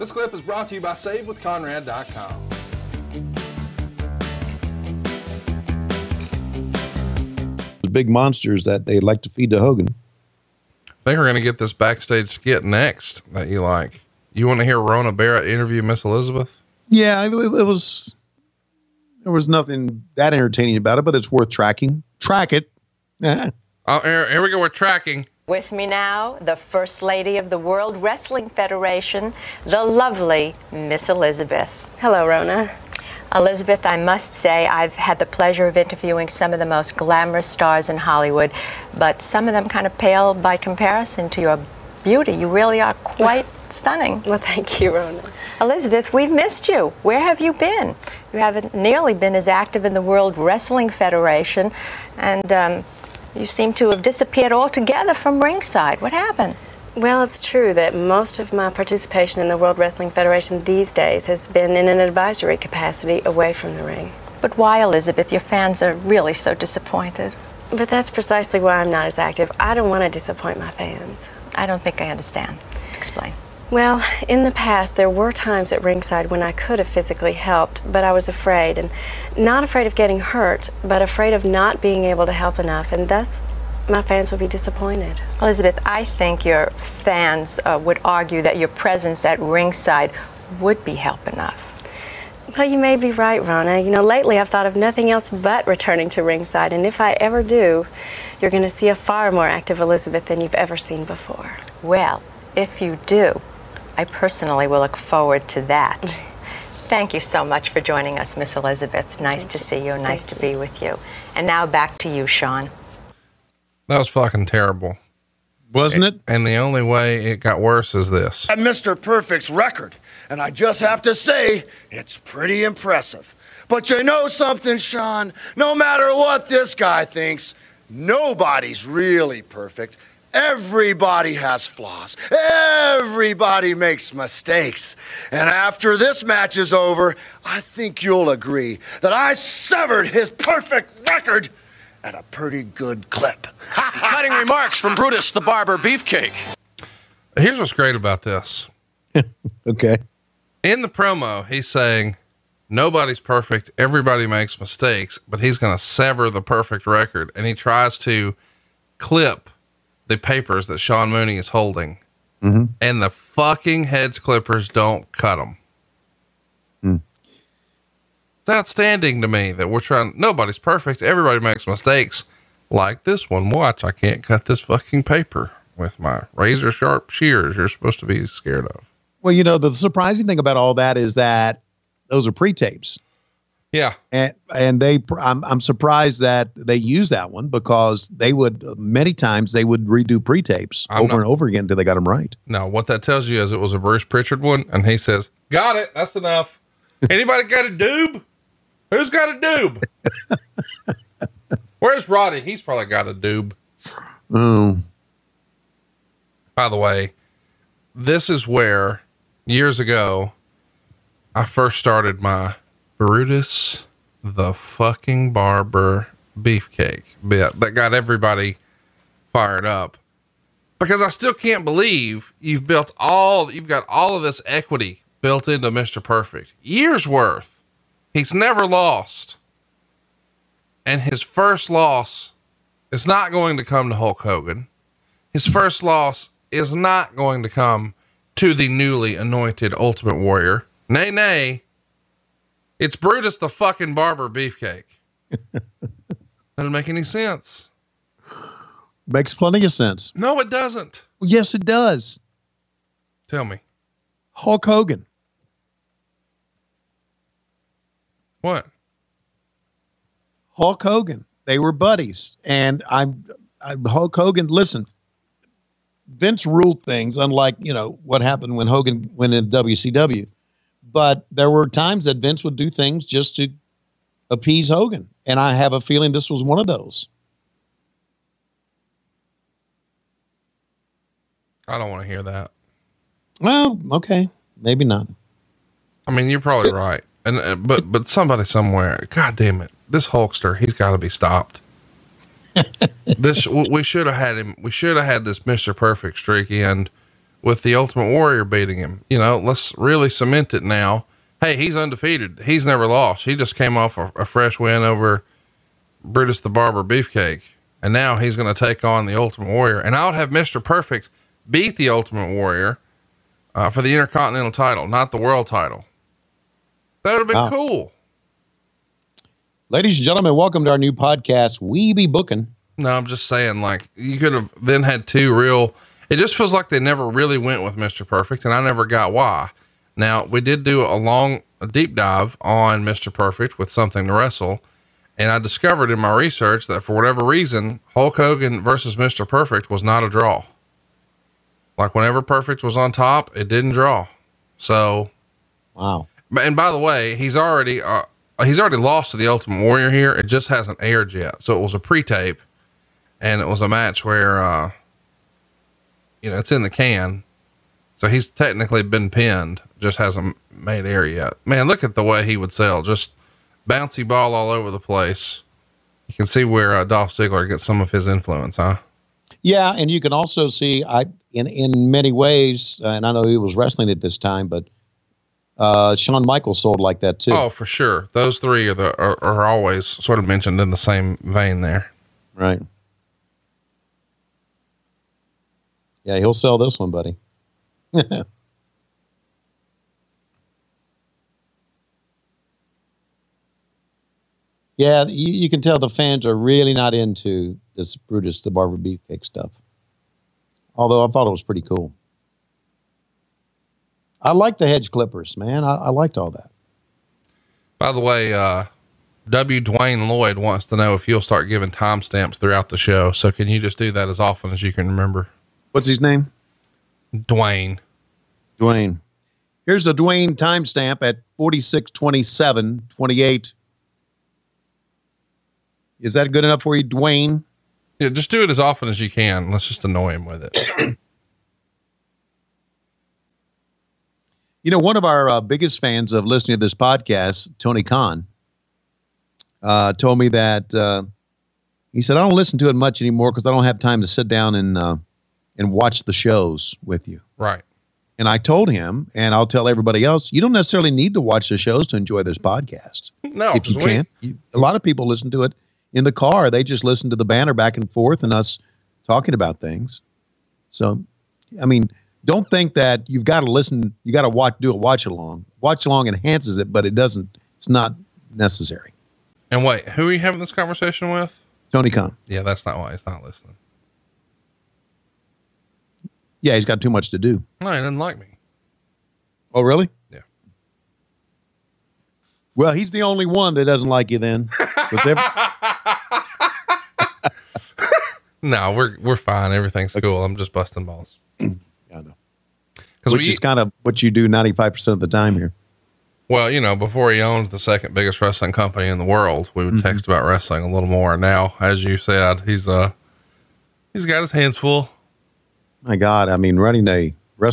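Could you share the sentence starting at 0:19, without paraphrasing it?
There was nothing that entertaining about it, but it's worth tracking.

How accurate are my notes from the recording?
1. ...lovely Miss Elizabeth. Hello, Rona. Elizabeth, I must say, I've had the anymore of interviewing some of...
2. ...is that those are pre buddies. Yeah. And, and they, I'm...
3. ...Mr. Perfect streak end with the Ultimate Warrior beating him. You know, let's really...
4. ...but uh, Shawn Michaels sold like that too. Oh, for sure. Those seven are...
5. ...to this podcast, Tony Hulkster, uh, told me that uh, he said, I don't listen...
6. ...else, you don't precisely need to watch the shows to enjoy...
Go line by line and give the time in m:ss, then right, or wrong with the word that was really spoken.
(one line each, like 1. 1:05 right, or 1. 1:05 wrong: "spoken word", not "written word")
1. 0:29 wrong: "pleasure", not "anymore"
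2. 3:00 wrong: "tapes", not "buddies"
3. 4:55 right
4. 6:14 wrong: "three", not "seven"
5. 7:16 wrong: "Khan", not "Hulkster"
6. 7:30 wrong: "necessarily", not "precisely".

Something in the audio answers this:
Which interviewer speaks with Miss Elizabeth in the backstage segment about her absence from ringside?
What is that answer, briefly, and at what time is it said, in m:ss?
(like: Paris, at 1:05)
Rona Barrett, at 0:14.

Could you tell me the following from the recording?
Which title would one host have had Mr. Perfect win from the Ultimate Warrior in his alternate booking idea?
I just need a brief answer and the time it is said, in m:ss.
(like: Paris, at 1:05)
Intercontinental title, at 5:13.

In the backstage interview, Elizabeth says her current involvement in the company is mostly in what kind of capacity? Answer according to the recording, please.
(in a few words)
advisory.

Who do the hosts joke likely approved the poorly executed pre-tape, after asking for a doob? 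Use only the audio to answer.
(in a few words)
Bruce Prichard.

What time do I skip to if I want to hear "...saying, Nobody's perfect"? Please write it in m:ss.
2:31.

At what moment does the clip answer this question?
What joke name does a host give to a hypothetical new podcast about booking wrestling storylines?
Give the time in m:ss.
5:21.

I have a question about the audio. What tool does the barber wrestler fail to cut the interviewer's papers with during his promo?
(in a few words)
hedge clippers.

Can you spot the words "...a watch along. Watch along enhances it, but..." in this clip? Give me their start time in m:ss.
7:44.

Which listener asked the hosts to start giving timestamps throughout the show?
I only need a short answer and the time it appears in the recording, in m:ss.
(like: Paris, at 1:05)
W. Dwayne Lloyd, at 6:49.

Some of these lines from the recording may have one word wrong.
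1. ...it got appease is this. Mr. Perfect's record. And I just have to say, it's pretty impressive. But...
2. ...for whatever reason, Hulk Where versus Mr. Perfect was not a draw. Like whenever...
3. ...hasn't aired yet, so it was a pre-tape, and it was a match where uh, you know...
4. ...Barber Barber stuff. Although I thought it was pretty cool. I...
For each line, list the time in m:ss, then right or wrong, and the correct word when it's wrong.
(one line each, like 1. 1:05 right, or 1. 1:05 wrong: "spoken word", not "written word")
1. 1:57 wrong: "worse", not "appease"
2. 5:36 wrong: "Hogan", not "Where"
3. 5:50 right
4. 6:38 wrong: "Beefcake", not "Barber".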